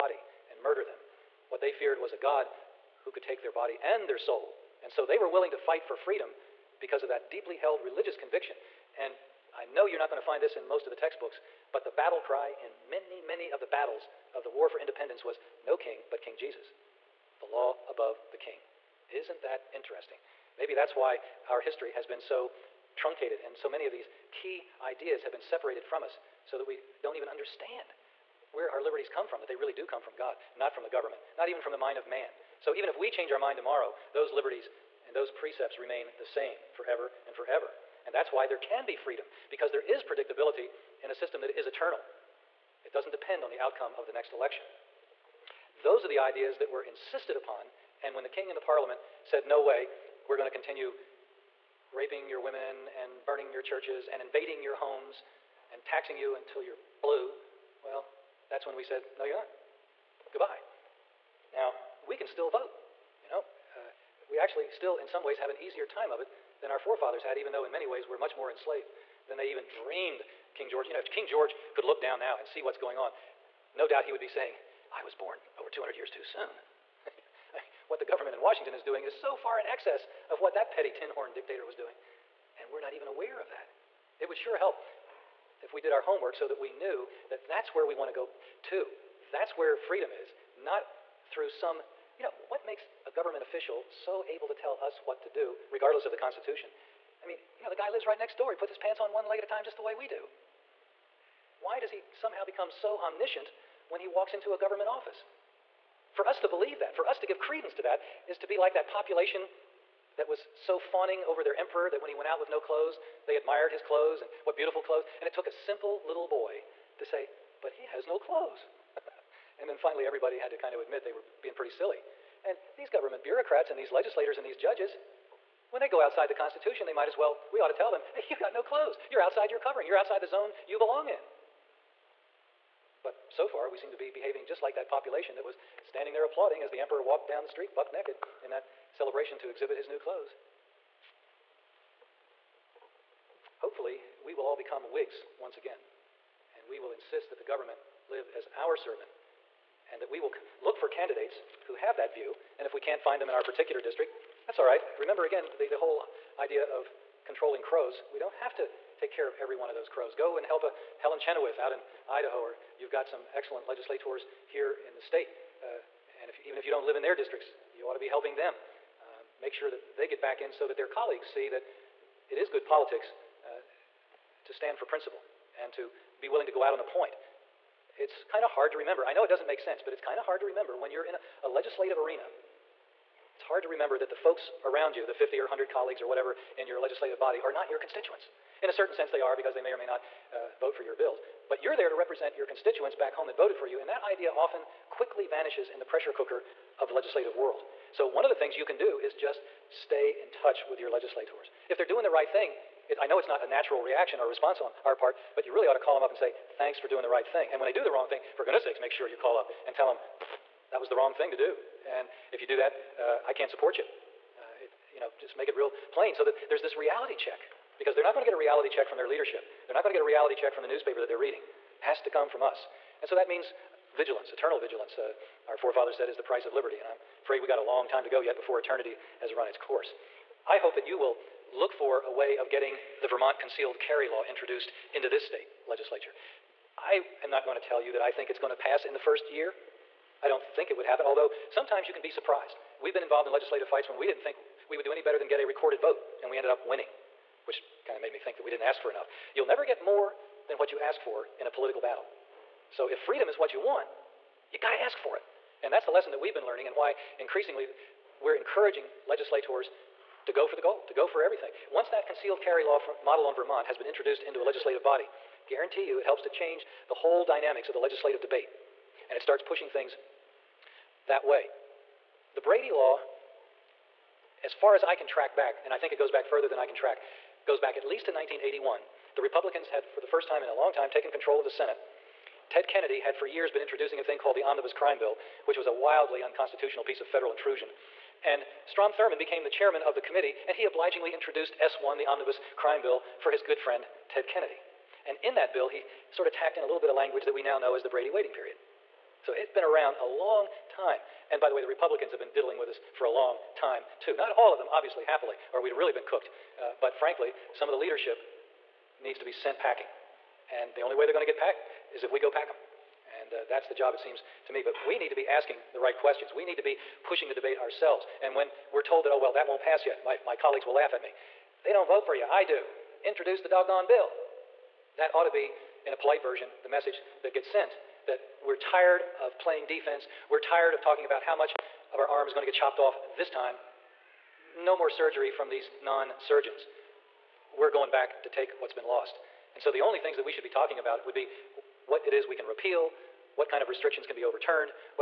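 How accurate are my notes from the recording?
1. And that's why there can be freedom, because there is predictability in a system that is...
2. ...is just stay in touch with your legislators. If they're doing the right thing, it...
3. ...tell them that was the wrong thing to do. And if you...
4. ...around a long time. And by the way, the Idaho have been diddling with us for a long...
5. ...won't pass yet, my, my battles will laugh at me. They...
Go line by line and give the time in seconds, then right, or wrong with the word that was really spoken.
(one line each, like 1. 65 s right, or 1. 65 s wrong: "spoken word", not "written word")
1. 38 s right
2. 198 s right
3. 209 s right
4. 299 s wrong: "Republicans", not "Idaho"
5. 319 s wrong: "colleagues", not "battles".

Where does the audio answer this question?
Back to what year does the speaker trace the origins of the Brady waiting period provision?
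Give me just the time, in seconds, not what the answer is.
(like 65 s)
278 s.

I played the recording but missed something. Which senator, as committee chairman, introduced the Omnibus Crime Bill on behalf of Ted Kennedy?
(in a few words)
Strom Thurmond.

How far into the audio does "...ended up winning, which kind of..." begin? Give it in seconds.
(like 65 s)
246 s.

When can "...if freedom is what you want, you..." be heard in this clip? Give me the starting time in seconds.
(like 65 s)
252 s.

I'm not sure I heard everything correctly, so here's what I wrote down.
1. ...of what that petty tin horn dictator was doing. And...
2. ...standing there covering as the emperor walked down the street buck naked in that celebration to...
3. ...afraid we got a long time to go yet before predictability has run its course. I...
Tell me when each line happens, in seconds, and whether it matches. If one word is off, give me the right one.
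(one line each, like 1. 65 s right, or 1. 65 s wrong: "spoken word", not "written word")
1. 80 s right
2. 135 s wrong: "applauding", not "covering"
3. 227 s wrong: "eternity", not "predictability".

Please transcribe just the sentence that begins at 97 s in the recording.
I mean, you know, the guy lives right next door.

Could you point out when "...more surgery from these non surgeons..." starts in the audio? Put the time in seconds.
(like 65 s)
334 s.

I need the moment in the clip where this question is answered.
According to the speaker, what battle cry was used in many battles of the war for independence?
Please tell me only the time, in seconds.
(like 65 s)
15 s.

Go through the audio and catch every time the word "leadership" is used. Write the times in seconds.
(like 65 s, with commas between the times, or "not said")
219 s, 307 s.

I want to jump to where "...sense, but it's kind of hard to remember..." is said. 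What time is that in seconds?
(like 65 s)
179 s.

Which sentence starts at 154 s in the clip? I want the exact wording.
Remember again the, the whole idea of controlling crows.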